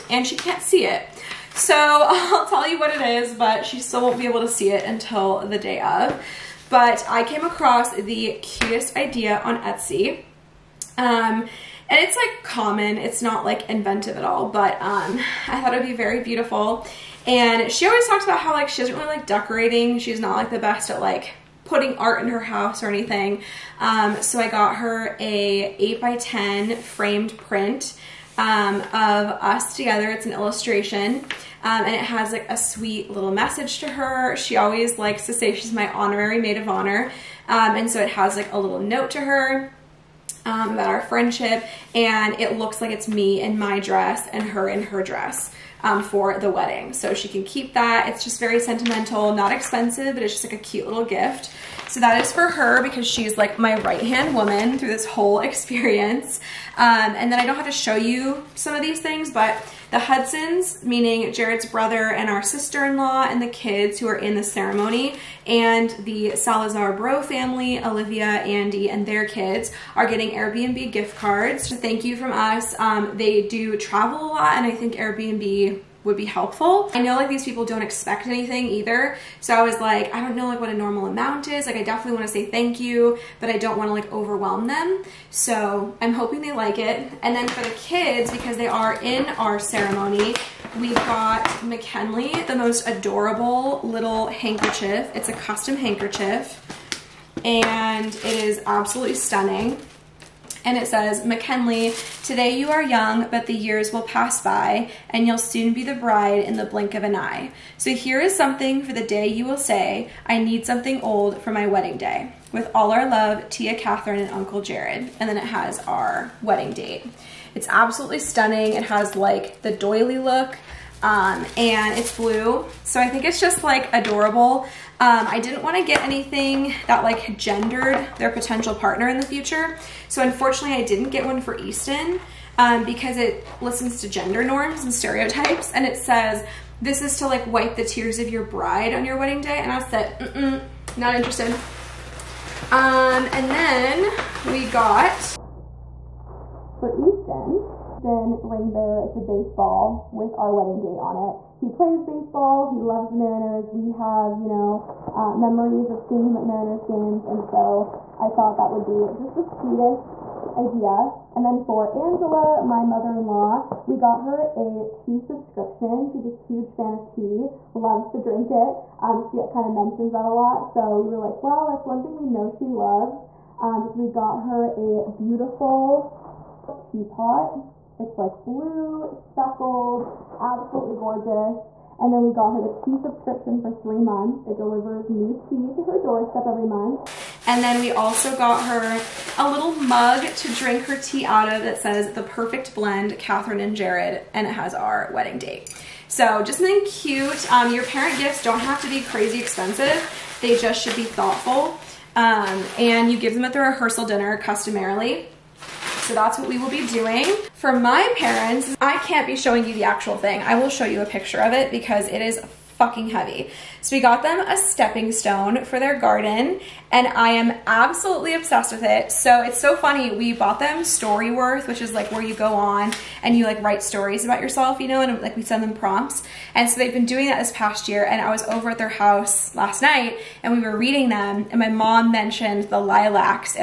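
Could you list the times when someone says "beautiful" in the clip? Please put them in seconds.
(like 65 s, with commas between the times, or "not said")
16 s, 175 s.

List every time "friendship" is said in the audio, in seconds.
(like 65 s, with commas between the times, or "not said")
41 s.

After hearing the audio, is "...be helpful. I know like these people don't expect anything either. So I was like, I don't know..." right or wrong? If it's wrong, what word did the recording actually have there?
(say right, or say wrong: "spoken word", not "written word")
right.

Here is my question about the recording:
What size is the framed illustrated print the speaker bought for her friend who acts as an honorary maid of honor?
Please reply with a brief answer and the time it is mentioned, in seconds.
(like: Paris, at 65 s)
8 by 10, at 25 s.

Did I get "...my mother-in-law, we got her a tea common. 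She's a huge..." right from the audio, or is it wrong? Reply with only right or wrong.
wrong.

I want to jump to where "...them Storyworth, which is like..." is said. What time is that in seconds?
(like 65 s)
220 s.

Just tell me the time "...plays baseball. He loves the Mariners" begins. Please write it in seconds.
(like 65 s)
151 s.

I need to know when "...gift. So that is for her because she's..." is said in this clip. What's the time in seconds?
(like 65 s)
51 s.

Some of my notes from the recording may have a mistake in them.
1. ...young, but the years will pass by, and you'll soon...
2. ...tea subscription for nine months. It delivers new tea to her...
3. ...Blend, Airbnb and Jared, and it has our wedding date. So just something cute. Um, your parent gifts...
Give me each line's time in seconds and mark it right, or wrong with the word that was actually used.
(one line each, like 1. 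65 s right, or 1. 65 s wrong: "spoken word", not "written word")
1. 102 s right
2. 182 s wrong: "three", not "nine"
3. 192 s wrong: "Kathryn", not "Airbnb".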